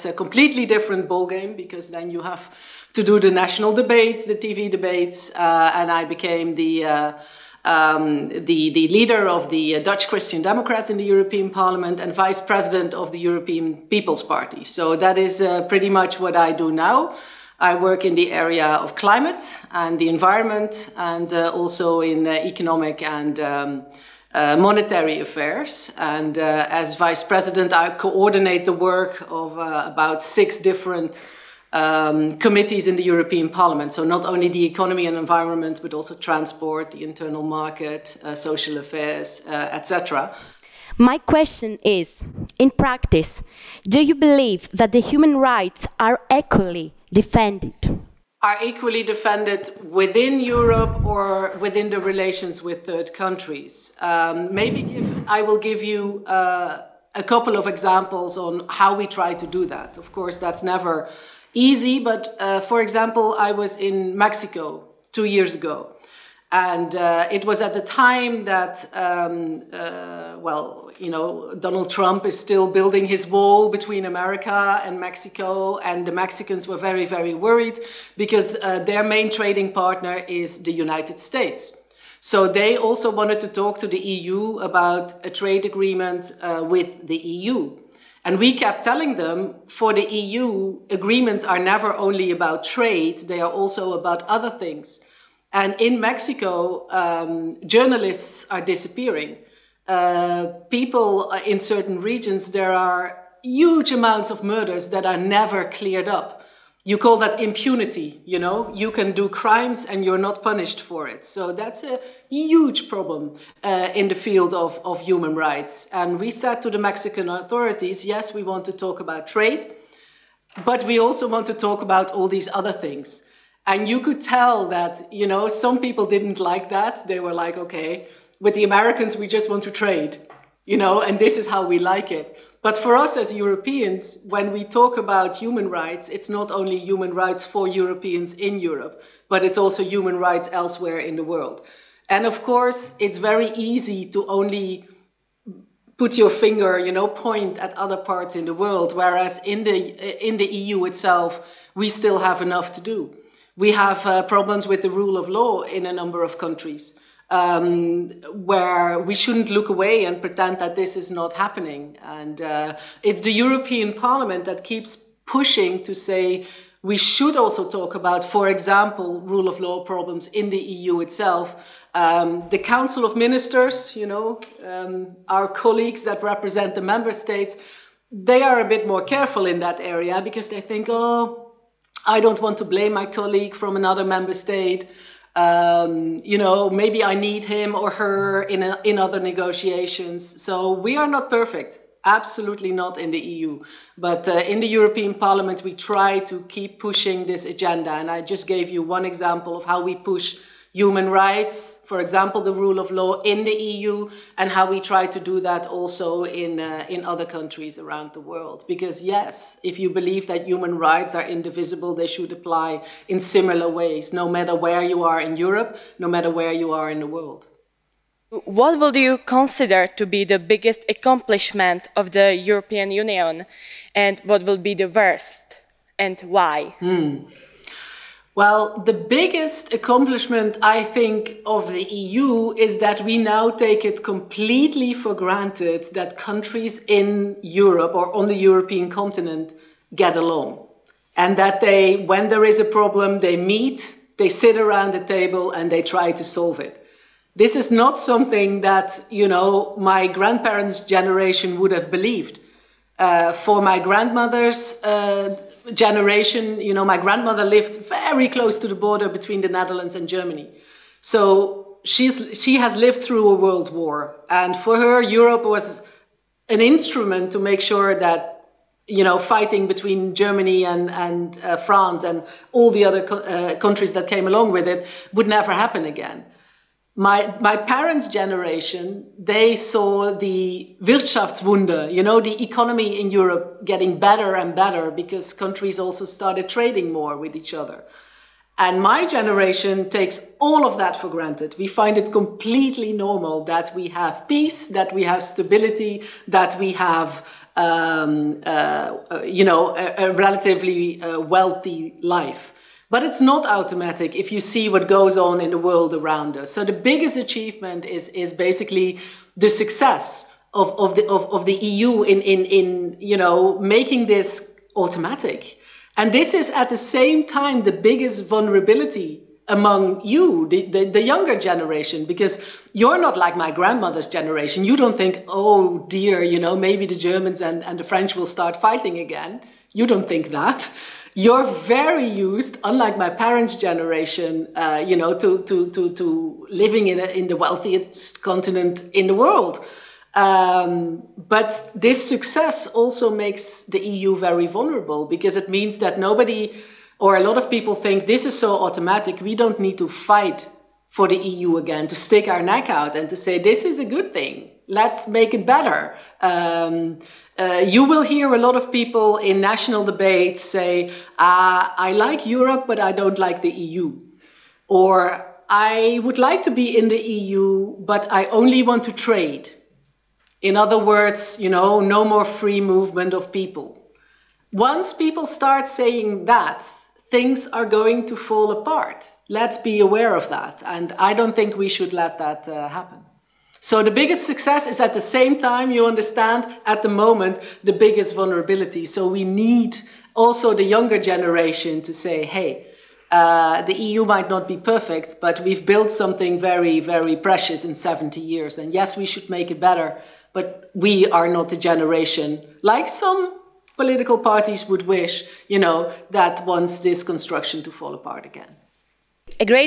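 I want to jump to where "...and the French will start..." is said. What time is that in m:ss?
5:27.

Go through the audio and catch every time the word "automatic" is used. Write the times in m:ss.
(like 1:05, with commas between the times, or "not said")
5:03, 5:14, 5:48.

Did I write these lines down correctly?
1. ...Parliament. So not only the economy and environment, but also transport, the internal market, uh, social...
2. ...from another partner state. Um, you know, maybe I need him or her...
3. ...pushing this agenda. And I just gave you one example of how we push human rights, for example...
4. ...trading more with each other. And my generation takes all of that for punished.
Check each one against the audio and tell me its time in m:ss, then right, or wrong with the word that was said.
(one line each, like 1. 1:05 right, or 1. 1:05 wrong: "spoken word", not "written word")
1. 0:33 right
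2. 3:03 wrong: "member", not "partner"
3. 3:16 right
4. 4:46 wrong: "granted", not "punished".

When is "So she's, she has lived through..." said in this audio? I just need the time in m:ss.
4:21.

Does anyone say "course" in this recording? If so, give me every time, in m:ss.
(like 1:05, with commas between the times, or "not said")
1:00, 2:22.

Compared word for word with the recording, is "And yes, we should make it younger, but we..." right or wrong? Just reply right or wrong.
wrong.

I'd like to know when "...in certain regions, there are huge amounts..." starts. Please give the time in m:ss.
1:41.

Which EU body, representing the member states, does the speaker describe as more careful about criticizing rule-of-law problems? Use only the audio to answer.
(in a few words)
Council of Ministers.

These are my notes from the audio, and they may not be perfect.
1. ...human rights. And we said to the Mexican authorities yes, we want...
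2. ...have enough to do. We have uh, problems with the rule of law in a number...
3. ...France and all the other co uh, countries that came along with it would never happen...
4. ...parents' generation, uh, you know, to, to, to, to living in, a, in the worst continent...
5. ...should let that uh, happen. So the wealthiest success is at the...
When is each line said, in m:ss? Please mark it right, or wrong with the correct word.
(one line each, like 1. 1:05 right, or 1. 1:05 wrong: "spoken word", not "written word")
1. 1:54 right
2. 2:32 right
3. 4:31 right
4. 5:33 wrong: "wealthiest", not "worst"
5. 6:21 wrong: "biggest", not "wealthiest".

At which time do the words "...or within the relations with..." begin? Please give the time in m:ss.
0:51.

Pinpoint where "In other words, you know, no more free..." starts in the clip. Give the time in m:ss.
6:10.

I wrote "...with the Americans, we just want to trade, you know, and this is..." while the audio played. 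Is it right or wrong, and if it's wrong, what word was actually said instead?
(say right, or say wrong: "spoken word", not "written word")
right.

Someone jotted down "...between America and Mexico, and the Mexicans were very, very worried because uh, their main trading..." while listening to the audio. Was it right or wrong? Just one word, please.
right.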